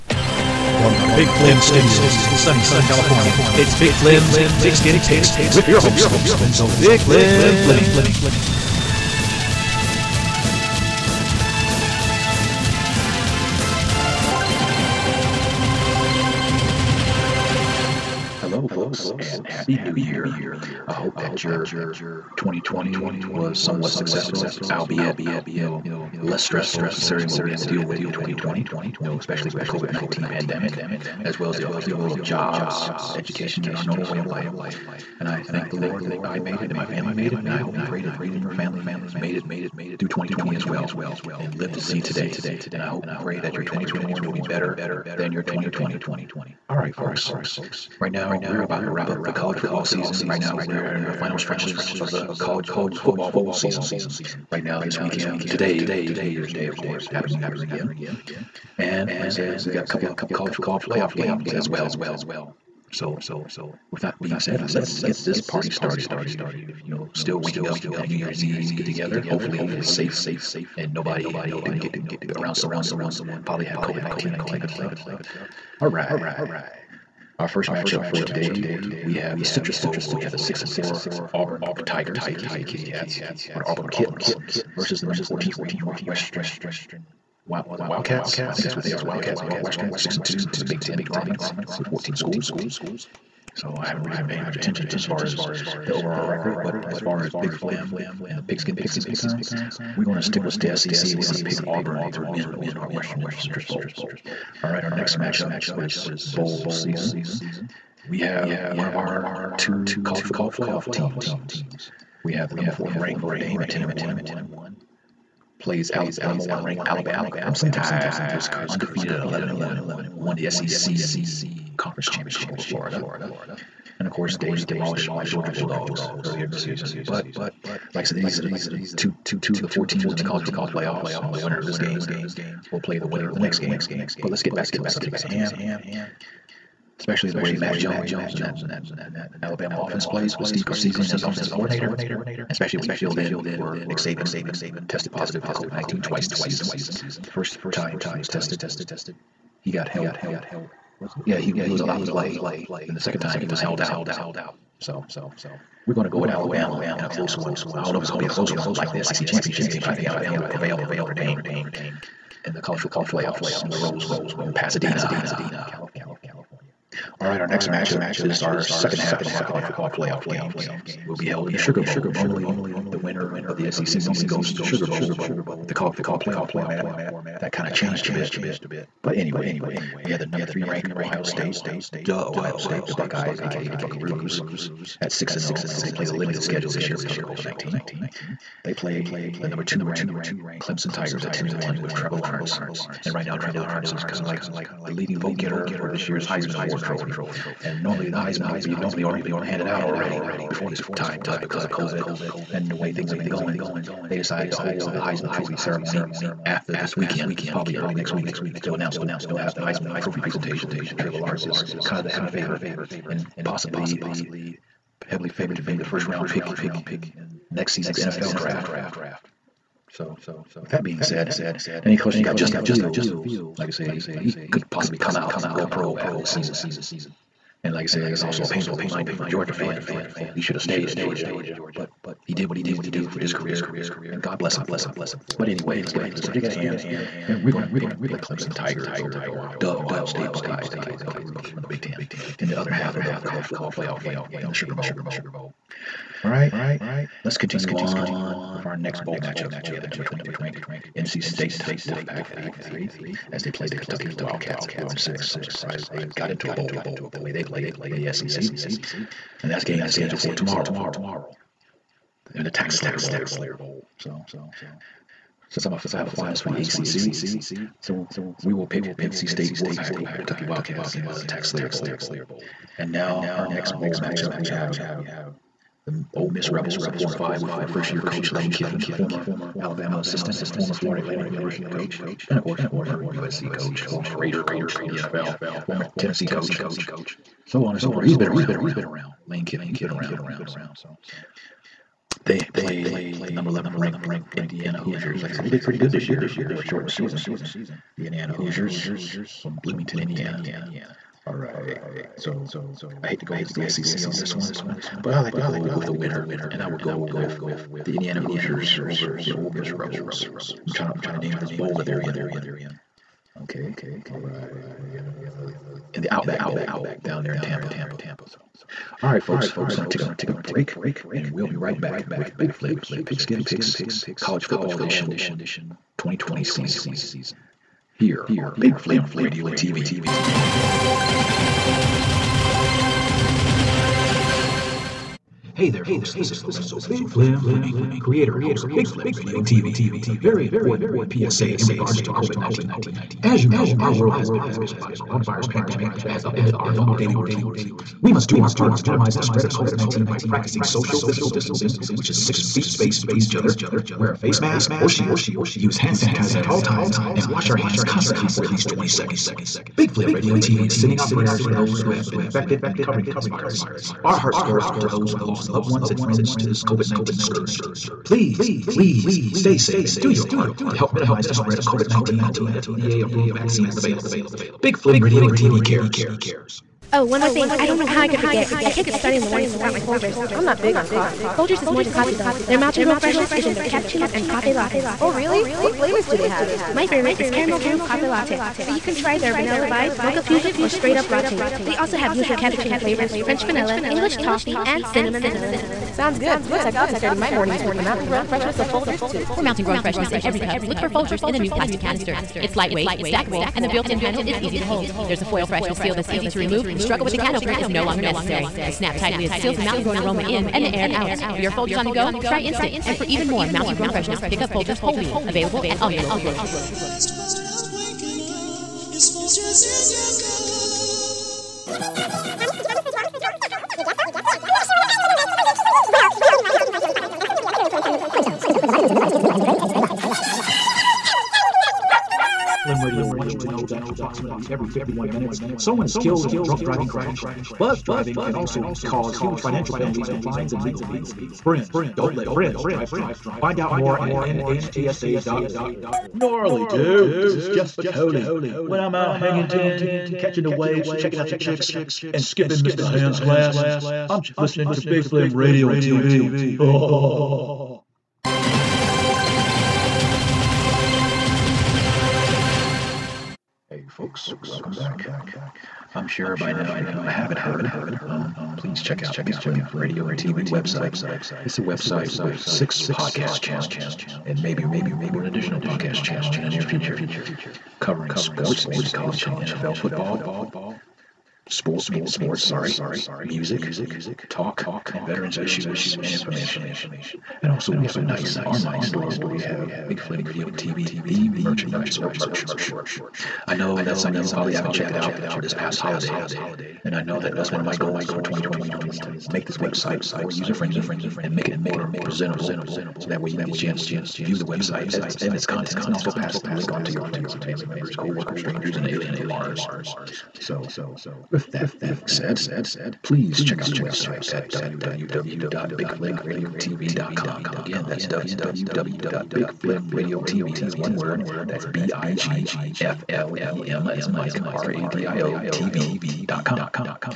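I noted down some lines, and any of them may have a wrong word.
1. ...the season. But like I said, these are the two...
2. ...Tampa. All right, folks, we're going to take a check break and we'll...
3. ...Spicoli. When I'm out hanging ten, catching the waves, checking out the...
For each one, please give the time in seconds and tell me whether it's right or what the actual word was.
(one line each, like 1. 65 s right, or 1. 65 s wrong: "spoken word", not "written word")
1. 126 s right
2. 317 s wrong: "quick", not "check"
3. 447 s right.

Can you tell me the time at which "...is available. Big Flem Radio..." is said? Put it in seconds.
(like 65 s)
373 s.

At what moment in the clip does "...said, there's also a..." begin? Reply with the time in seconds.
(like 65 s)
227 s.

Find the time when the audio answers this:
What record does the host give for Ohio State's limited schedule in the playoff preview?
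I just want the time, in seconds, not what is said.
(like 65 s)
185 s.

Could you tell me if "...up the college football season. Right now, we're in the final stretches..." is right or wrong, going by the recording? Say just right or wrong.
right.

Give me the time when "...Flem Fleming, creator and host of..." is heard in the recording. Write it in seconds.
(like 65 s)
337 s.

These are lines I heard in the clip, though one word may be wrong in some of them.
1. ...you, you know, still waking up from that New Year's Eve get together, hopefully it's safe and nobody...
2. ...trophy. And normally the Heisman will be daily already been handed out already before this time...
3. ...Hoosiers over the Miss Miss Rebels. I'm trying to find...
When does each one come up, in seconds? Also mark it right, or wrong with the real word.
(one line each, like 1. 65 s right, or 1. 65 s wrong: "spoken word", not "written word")
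1. 66 s right
2. 196 s wrong: "normally", not "daily"
3. 308 s wrong: "Ole", not "Miss".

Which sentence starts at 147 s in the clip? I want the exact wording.
The first time he was tested, he got help was yeah he he was allowed to play.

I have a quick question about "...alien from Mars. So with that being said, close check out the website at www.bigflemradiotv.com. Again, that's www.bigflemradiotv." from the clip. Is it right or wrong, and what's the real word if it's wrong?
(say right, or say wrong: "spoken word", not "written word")
wrong: "please", not "close".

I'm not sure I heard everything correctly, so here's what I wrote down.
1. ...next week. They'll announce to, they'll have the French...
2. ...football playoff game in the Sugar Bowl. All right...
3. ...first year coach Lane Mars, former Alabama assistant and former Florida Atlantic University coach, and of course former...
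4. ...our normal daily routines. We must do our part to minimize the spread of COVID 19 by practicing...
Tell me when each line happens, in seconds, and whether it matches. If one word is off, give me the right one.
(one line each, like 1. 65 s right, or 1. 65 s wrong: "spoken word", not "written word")
1. 207 s wrong: "Heisman", not "French"
2. 243 s right
3. 277 s wrong: "Kiffin", not "Mars"
4. 346 s right.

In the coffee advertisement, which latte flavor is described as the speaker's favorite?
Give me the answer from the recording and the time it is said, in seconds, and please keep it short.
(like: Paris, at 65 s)
Caramel Groove, at 387 s.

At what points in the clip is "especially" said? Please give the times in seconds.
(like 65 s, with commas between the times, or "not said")
29 s, 136 s, 142 s.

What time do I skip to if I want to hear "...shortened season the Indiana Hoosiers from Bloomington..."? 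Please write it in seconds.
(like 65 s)
296 s.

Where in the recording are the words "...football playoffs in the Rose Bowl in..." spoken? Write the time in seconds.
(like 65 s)
162 s.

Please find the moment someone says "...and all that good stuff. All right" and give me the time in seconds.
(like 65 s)
74 s.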